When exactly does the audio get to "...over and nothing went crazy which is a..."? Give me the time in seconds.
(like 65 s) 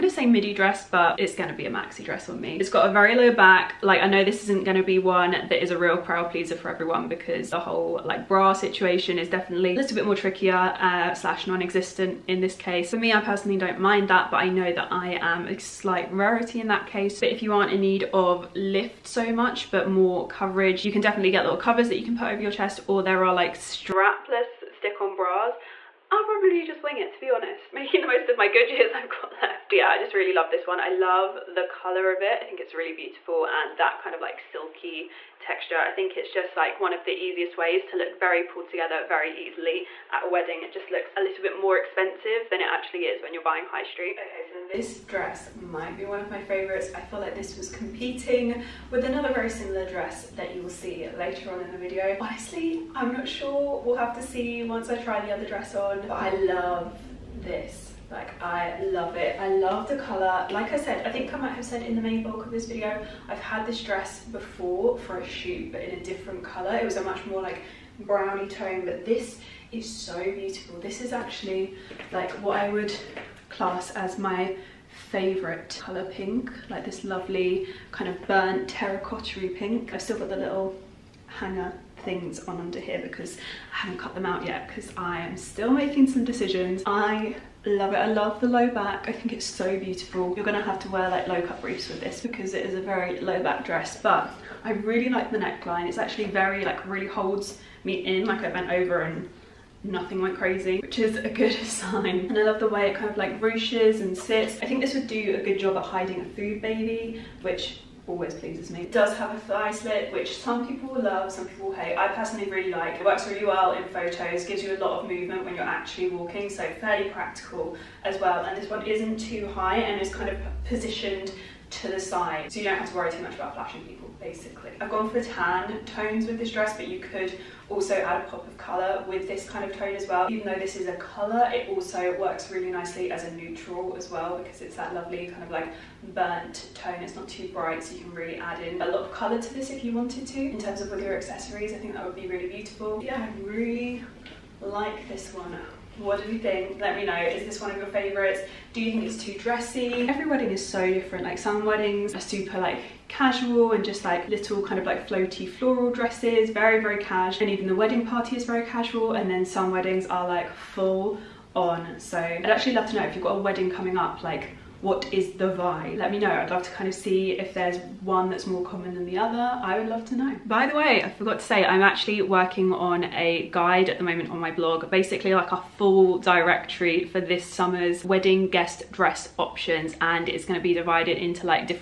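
98 s.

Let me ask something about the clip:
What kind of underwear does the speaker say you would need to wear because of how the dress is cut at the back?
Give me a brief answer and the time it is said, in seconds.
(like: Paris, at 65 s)
low cut briefs, at 91 s.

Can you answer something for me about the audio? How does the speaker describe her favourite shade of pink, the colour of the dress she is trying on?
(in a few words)
burnt terracotta pink.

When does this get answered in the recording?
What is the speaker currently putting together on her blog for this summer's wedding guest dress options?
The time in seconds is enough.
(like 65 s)
175 s.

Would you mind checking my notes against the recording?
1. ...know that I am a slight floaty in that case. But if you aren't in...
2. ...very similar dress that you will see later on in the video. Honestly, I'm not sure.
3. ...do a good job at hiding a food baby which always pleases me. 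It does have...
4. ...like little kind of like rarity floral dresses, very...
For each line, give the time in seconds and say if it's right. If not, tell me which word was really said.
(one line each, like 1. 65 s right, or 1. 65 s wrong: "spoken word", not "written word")
1. 14 s wrong: "rarity", not "floaty"
2. 49 s right
3. 105 s right
4. 154 s wrong: "floaty", not "rarity".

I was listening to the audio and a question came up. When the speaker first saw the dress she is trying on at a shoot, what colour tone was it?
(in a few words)
browny tone.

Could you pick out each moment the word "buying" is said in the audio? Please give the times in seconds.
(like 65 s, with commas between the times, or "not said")
43 s.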